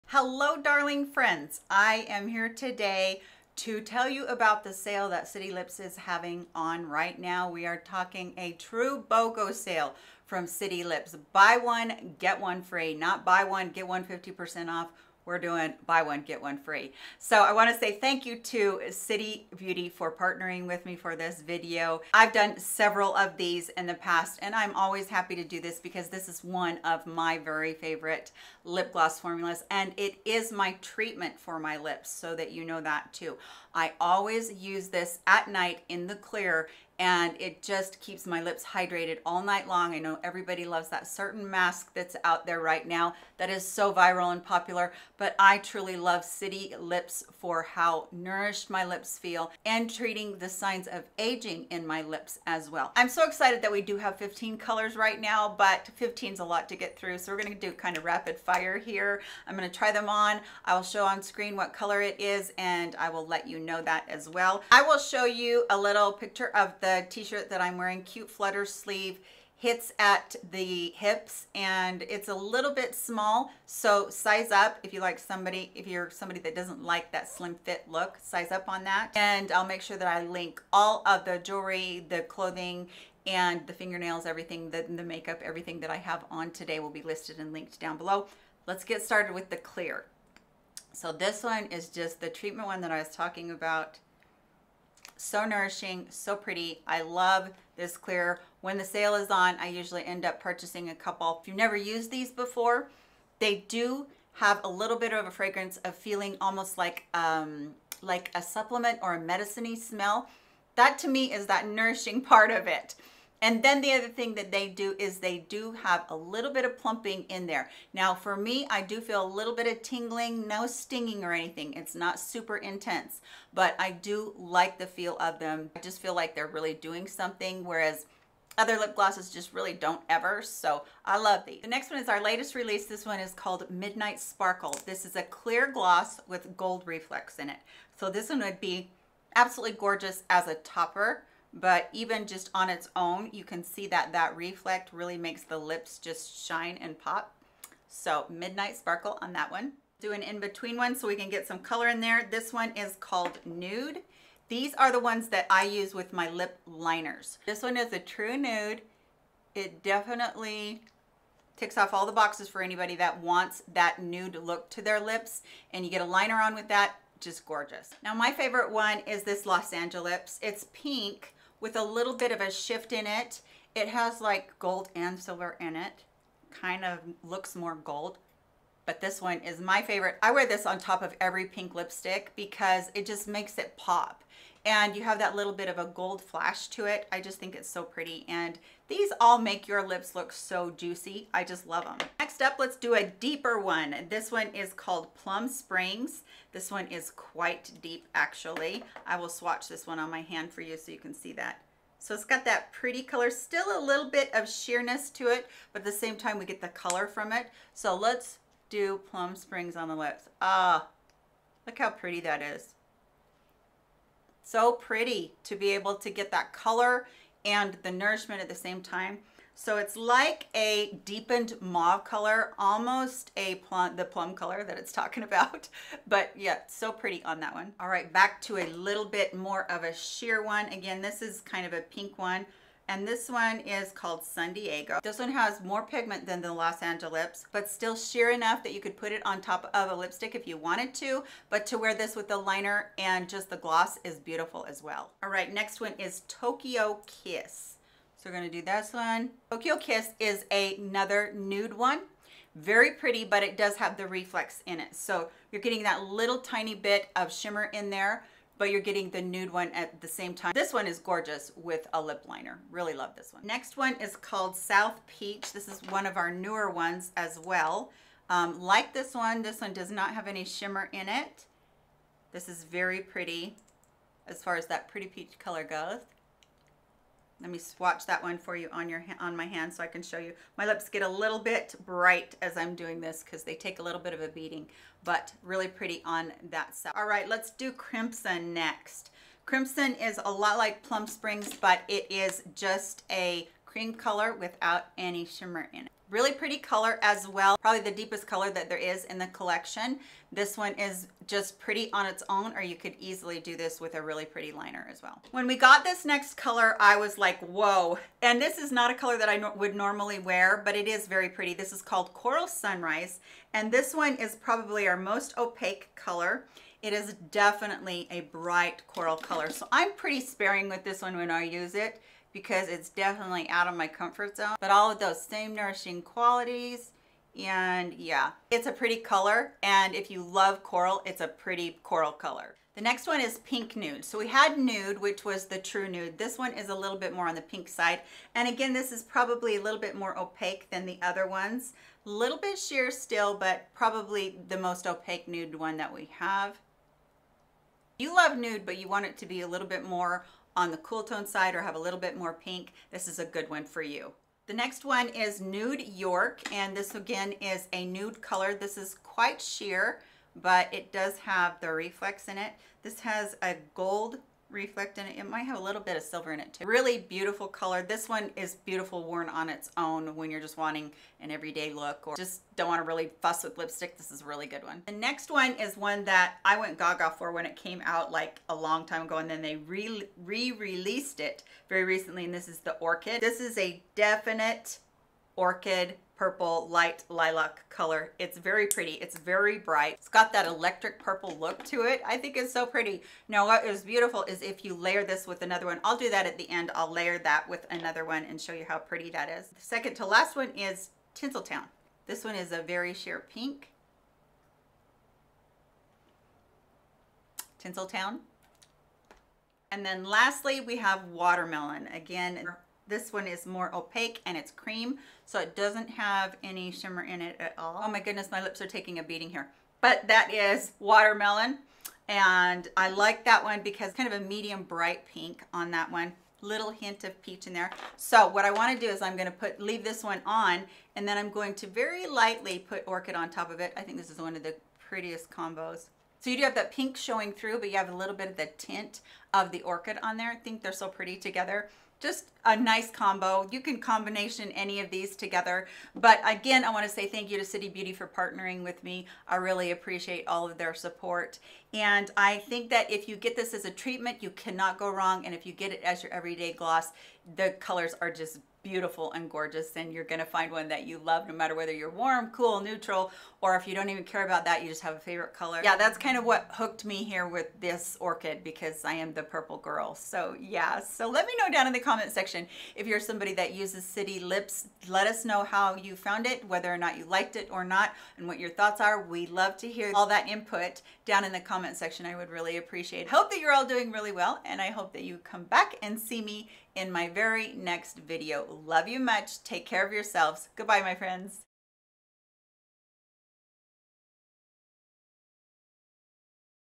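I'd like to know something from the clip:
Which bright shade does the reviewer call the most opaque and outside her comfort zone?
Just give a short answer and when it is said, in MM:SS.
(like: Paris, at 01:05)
Coral Sunrise, at 05:12.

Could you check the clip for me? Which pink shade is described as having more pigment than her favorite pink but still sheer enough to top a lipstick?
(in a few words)
San Diego.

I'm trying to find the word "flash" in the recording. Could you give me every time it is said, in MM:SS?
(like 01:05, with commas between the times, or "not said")
03:06.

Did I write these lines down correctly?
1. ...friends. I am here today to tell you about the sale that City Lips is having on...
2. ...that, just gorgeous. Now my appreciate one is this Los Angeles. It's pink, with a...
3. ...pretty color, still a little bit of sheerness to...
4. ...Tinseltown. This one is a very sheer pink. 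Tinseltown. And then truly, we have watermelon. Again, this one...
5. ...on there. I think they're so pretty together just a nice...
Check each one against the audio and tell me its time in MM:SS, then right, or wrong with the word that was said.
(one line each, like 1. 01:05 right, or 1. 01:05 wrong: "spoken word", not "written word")
1. 00:01 right
2. 02:46 wrong: "favorite", not "appreciate"
3. 03:22 right
4. 06:41 wrong: "lastly", not "truly"
5. 07:20 right.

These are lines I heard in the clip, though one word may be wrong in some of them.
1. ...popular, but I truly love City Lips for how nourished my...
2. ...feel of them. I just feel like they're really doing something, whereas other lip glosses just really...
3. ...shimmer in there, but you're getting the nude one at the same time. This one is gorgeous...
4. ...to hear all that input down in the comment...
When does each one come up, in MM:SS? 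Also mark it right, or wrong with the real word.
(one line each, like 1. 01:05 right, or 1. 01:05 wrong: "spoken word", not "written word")
1. 00:44 right
2. 02:04 right
3. 04:17 right
4. 07:59 right.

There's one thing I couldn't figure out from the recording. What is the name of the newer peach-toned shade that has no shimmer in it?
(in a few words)
South Peach.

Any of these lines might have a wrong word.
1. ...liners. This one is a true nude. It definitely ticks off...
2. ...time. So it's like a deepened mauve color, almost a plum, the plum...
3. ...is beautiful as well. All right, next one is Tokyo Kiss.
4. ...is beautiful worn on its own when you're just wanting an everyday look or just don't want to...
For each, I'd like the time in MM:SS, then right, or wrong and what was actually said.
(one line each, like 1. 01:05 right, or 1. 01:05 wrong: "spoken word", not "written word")
1. 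02:36 right
2. 03:38 right
3. 04:04 right
4. 06:08 right.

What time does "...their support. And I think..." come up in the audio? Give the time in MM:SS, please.
07:30.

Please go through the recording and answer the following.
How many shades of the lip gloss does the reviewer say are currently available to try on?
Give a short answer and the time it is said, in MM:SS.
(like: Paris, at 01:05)
15, at 00:54.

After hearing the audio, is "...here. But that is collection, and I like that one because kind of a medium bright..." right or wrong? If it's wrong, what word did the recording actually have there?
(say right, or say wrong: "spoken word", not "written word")
wrong: "watermelon", not "collection".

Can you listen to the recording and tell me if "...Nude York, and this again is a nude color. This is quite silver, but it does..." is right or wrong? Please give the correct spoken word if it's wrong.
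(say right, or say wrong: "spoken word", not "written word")
wrong: "sheer", not "silver".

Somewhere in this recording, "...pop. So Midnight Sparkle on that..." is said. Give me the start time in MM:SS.
02:26.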